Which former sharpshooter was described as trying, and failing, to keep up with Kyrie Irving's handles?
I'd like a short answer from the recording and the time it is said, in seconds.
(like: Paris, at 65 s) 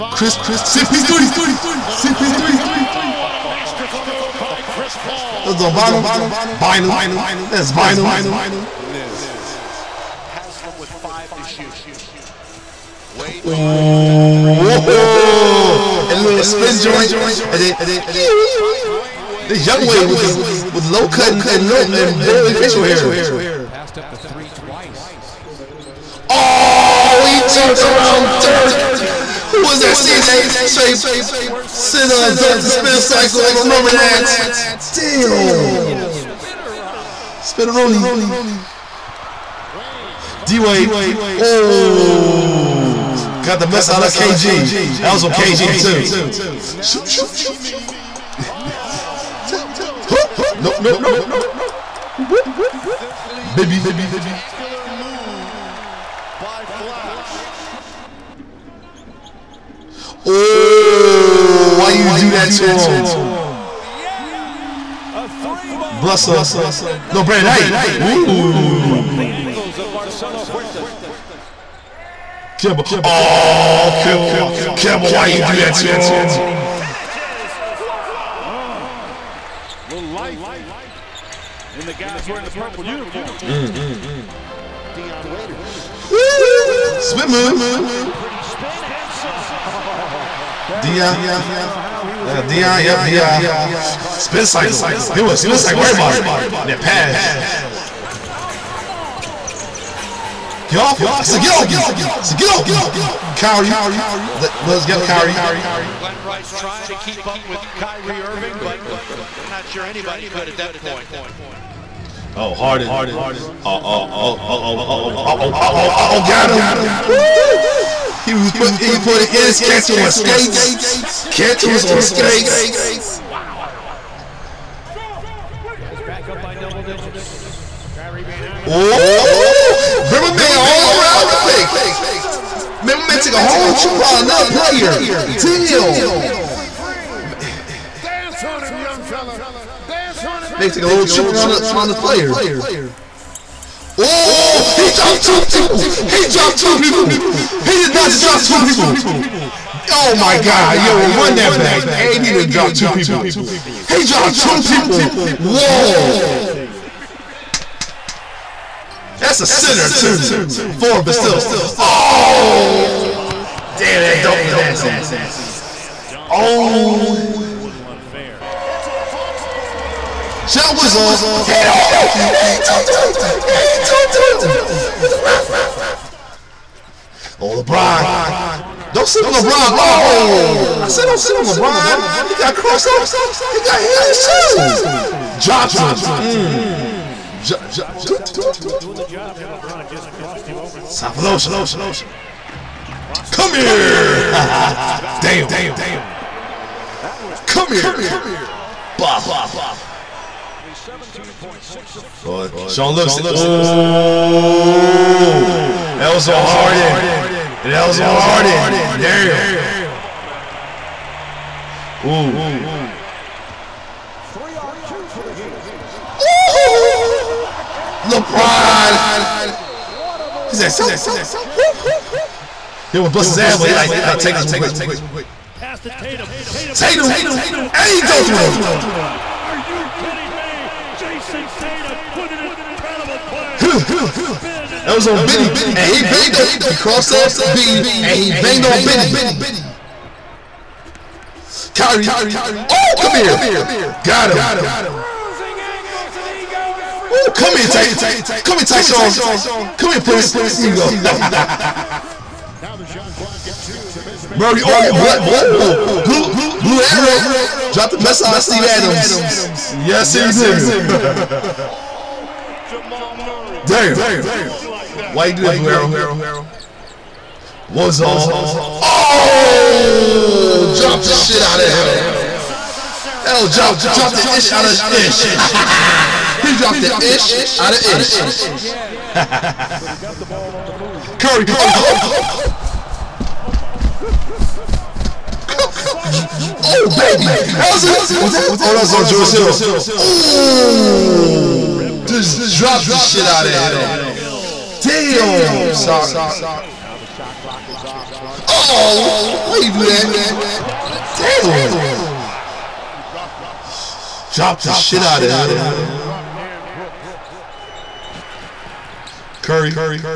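Glen Rice, at 105 s.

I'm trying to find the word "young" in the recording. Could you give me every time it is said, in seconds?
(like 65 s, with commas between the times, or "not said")
19 s, 138 s.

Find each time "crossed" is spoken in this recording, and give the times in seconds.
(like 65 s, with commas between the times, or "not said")
182 s, 190 s, 236 s.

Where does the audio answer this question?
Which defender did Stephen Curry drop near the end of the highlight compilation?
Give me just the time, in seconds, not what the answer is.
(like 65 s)
289 s.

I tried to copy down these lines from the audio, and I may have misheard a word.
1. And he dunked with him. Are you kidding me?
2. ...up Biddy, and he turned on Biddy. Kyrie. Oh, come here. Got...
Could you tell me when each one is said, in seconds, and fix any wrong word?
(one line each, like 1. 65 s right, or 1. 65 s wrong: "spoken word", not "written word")
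1. 227 s right
2. 237 s wrong: "banged", not "turned".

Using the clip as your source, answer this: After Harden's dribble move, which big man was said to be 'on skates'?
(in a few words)
Kanter.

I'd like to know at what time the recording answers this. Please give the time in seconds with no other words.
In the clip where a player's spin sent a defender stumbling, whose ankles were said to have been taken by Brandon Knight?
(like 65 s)
69 s.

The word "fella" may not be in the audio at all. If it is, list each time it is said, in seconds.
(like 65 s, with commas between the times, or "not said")
139 s.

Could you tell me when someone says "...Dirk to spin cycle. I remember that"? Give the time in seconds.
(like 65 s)
32 s.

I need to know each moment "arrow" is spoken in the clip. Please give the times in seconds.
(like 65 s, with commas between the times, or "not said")
256 s, 265 s.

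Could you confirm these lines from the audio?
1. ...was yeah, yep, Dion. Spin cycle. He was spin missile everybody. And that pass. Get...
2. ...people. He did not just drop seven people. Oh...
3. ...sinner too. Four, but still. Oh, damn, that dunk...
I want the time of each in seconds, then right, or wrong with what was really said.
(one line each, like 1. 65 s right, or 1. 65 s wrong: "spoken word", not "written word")
1. 92 s wrong: "cycle", not "missile"
2. 146 s wrong: "two", not "seven"
3. 159 s right.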